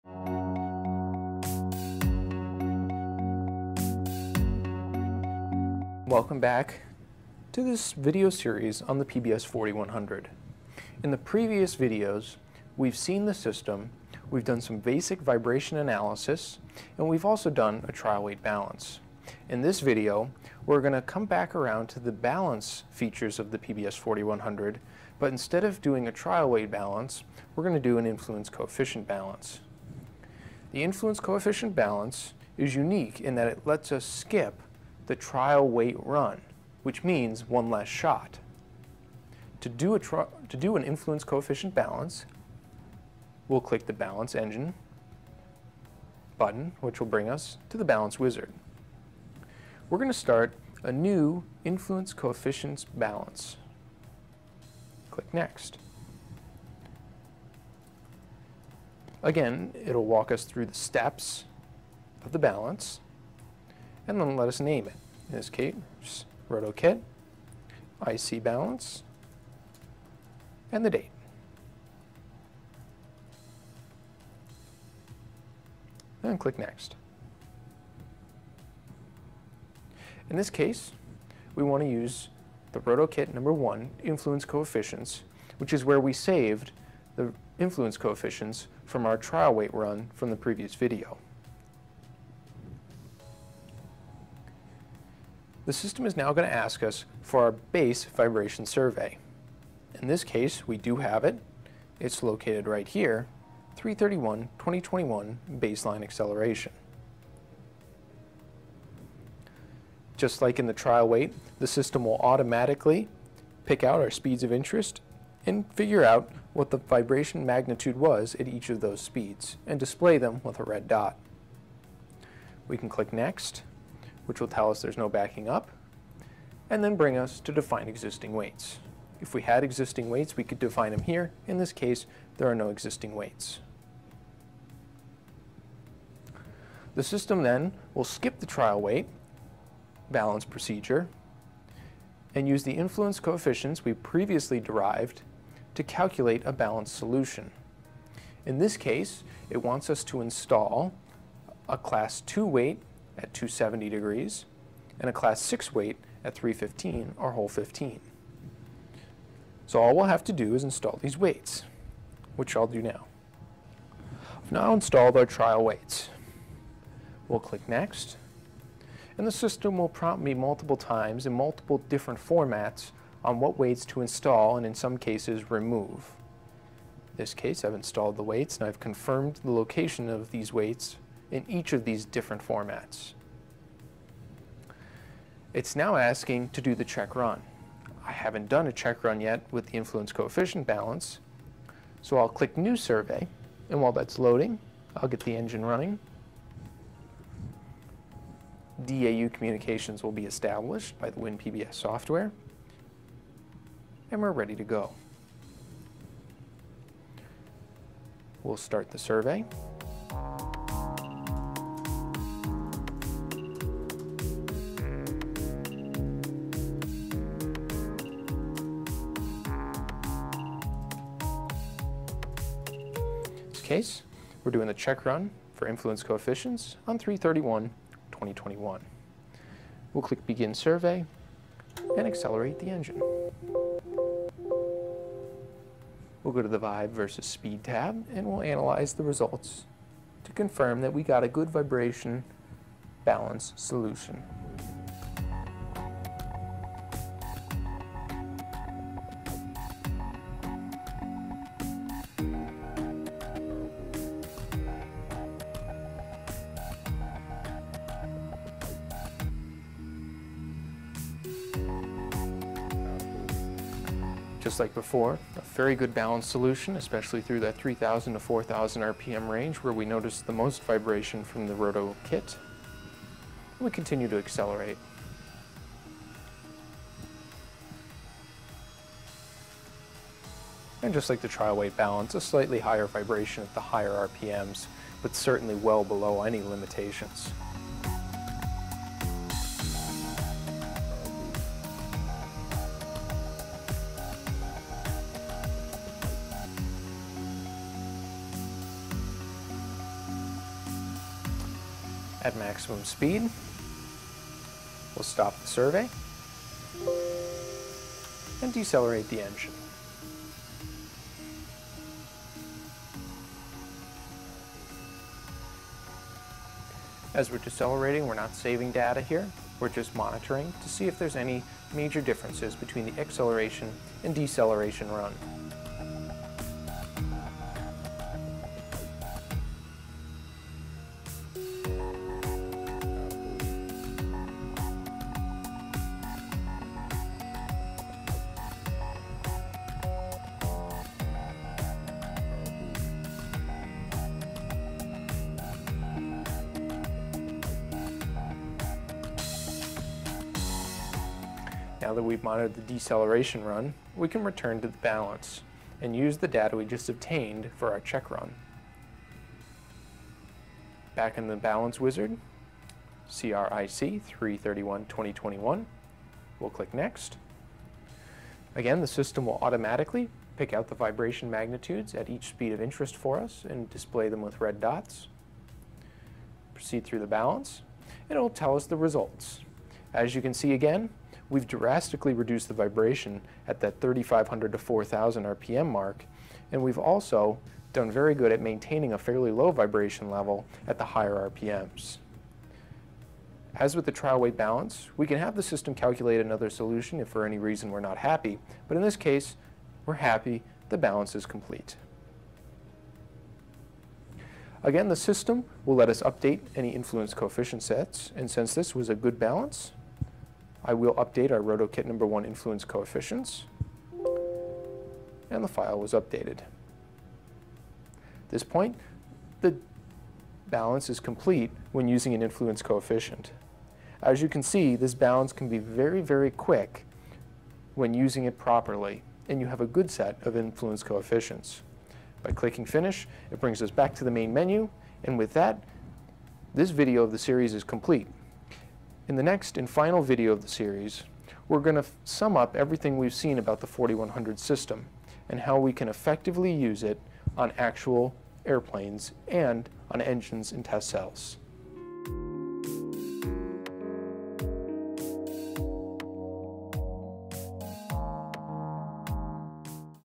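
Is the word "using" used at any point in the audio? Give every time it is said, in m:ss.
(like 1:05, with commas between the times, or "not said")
7:01, 7:07.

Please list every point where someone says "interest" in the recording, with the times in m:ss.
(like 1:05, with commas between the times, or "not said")
1:54, 6:12.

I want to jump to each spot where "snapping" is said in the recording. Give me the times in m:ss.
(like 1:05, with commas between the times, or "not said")
not said.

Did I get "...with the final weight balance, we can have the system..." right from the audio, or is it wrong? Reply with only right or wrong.
wrong.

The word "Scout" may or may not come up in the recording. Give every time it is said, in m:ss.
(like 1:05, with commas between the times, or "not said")
not said.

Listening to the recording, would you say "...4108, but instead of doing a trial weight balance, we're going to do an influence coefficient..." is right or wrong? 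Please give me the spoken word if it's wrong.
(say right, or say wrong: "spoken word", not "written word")
wrong: "4100", not "4108".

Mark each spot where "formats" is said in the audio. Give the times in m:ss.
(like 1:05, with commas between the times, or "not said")
2:52, 3:02.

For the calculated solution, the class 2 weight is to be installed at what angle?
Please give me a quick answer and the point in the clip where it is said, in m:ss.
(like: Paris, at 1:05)
270 degrees, at 2:33.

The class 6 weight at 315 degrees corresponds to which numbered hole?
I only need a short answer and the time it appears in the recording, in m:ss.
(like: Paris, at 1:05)
Hole 15, at 2:37.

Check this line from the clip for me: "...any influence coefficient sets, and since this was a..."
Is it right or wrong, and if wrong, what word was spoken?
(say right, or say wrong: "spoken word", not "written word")
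right.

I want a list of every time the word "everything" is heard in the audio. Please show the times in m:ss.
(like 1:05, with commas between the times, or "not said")
7:22.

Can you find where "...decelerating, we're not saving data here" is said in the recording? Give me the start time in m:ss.
5:17.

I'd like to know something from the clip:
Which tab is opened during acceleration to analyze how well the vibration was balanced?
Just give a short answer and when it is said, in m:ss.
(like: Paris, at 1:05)
Vibe versus Speed, at 3:56.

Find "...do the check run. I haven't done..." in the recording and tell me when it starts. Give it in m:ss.
3:06.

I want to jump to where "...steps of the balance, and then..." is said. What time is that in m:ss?
1:00.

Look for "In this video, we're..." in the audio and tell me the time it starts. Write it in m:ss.
0:19.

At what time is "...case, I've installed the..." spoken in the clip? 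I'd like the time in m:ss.
2:57.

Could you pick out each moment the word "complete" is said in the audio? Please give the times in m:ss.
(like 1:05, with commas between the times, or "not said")
6:41, 7:00, 7:17.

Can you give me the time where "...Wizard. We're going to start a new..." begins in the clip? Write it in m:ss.
0:48.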